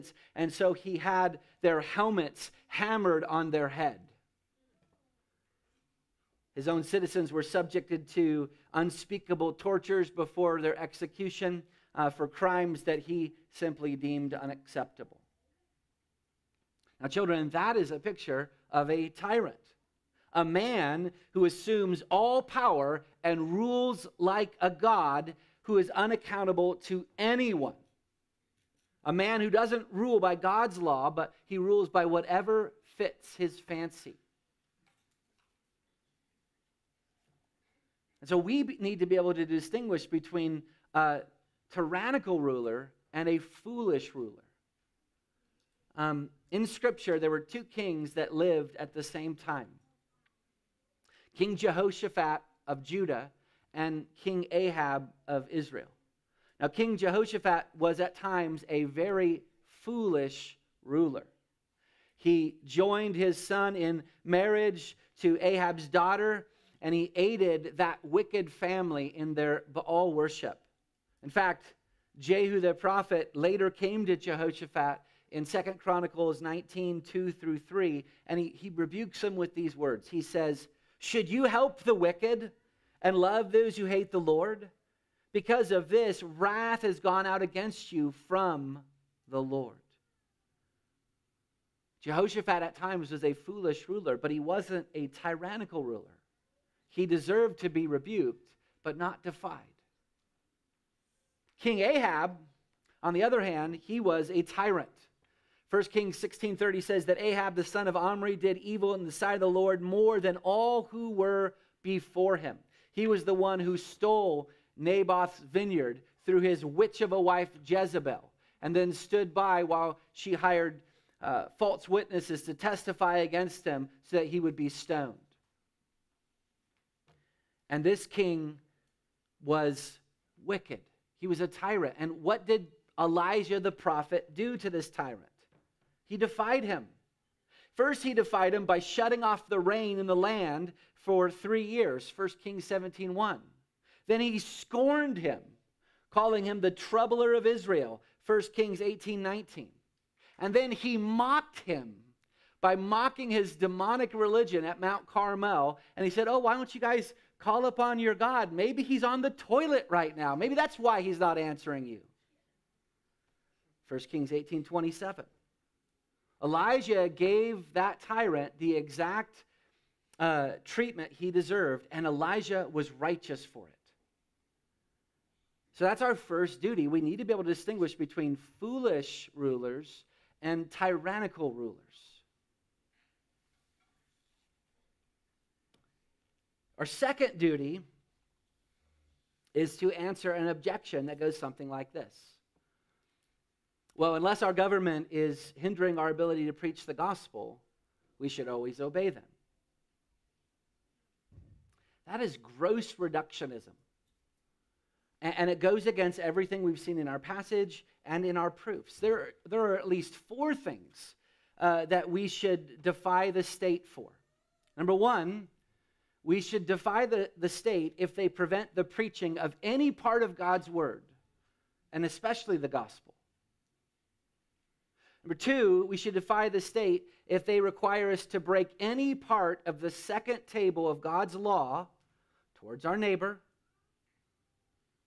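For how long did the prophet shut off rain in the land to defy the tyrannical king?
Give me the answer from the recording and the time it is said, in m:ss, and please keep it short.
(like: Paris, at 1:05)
3 years, at 2:21.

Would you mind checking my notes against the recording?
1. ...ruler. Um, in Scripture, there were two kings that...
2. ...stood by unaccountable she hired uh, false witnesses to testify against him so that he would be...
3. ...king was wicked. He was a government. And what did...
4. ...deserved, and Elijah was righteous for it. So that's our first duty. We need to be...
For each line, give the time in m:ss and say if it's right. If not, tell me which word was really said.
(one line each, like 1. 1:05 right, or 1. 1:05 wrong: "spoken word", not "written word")
1. 0:44 right
2. 1:58 wrong: "while", not "unaccountable"
3. 2:08 wrong: "tyrant", not "government"
4. 2:51 right.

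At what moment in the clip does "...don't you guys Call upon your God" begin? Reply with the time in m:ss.
2:36.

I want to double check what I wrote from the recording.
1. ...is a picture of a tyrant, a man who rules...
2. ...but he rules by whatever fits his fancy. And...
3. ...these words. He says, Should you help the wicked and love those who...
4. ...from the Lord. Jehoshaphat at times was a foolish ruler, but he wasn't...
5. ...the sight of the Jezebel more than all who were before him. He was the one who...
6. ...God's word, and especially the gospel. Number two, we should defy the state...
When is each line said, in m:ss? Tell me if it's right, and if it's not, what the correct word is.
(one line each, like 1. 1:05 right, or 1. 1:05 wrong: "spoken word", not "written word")
1. 0:17 wrong: "assumes", not "rules"
2. 0:31 right
3. 1:19 right
4. 1:28 right
5. 1:49 wrong: "Lord", not "Jezebel"
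6. 3:40 right.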